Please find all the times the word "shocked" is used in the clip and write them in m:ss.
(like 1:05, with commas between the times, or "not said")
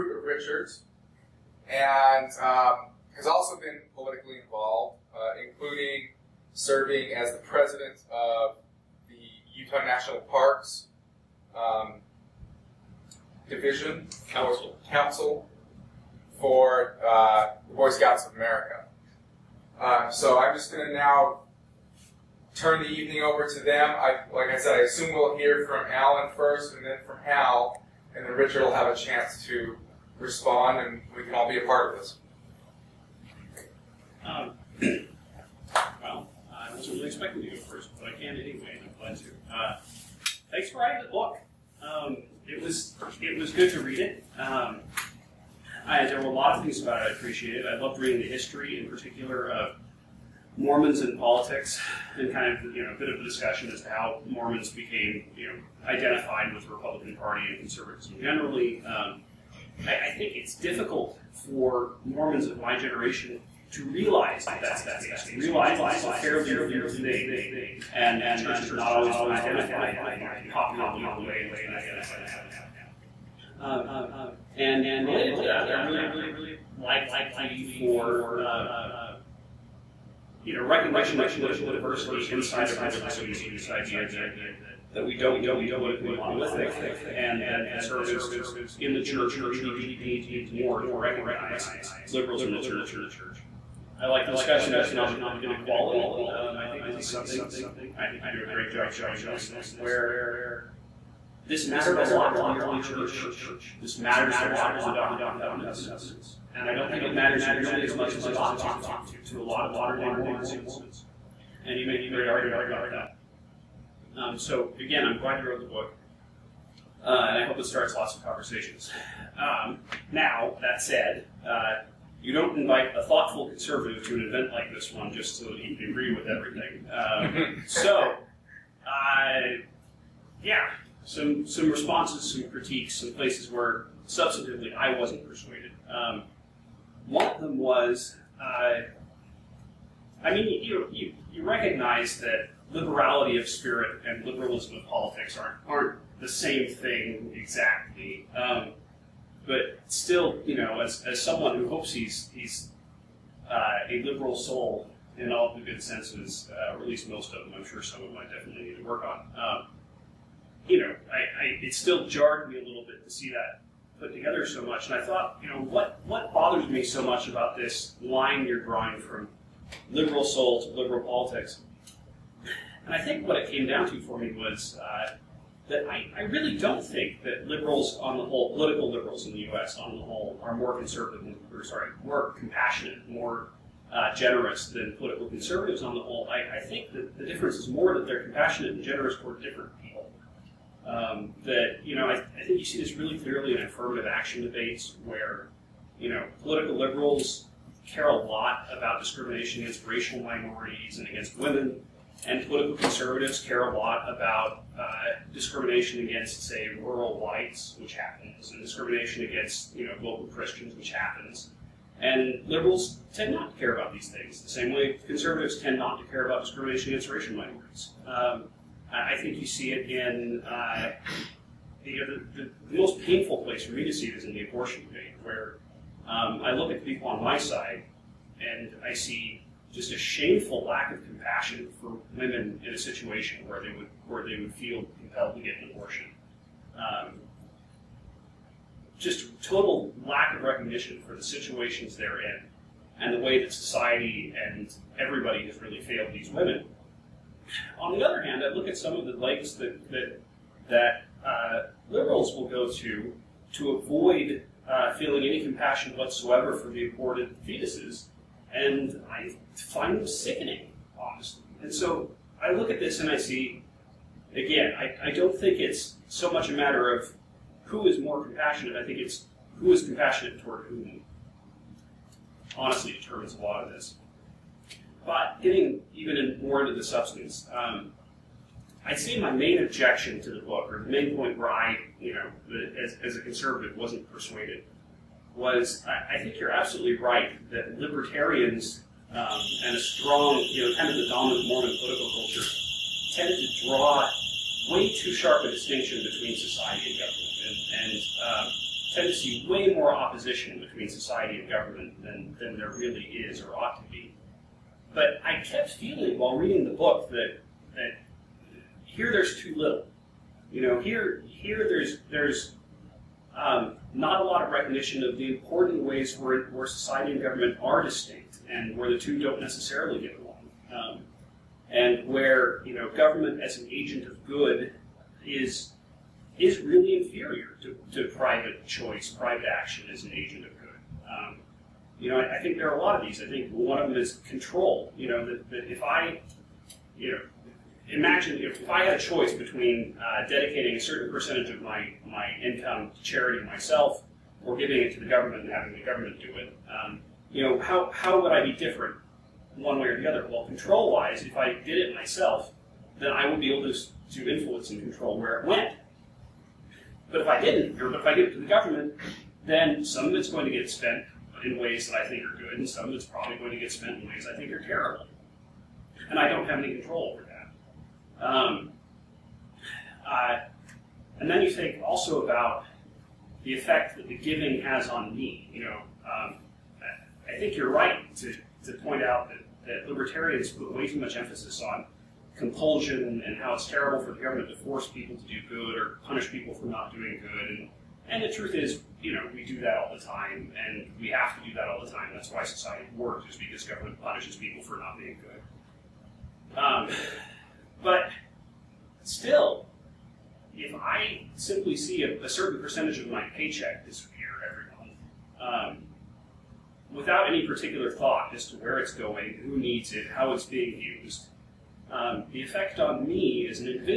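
not said.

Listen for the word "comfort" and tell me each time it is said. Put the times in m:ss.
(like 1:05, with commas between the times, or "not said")
not said.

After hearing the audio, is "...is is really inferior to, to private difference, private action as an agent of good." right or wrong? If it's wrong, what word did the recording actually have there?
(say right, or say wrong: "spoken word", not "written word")
wrong: "choice", not "difference".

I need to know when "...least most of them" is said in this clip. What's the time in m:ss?
2:36.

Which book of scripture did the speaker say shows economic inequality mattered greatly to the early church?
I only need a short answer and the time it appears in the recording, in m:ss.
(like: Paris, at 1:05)
Doctrine and Covenants, at 1:44.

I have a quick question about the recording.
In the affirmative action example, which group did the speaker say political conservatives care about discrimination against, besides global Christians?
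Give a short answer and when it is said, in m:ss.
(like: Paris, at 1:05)
rural whites, at 3:26.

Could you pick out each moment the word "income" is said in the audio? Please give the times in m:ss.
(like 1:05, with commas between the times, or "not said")
5:42.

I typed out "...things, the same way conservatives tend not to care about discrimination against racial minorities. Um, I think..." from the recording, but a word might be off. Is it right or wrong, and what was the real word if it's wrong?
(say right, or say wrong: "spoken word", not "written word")
right.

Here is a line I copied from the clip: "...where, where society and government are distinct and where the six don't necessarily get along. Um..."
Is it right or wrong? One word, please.
wrong.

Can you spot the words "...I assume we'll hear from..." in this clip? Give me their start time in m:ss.
0:24.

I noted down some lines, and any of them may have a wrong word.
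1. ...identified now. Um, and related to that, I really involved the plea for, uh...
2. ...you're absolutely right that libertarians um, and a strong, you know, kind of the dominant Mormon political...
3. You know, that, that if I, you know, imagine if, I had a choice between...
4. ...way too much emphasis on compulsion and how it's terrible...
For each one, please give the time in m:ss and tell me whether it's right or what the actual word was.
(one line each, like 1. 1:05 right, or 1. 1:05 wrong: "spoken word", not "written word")
1. 1:11 wrong: "liked", not "involved"
2. 4:46 right
3. 5:34 right
4. 6:20 right.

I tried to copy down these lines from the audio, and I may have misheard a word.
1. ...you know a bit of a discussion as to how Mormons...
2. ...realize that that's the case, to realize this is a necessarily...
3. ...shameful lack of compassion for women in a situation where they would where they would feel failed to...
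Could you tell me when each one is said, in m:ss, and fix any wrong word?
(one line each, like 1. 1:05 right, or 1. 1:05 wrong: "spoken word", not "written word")
1. 0:52 right
2. 1:03 wrong: "fairly", not "necessarily"
3. 3:49 wrong: "compelled", not "failed".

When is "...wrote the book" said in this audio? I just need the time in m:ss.
1:55.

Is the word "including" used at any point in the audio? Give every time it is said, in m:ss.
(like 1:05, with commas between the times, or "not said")
0:05.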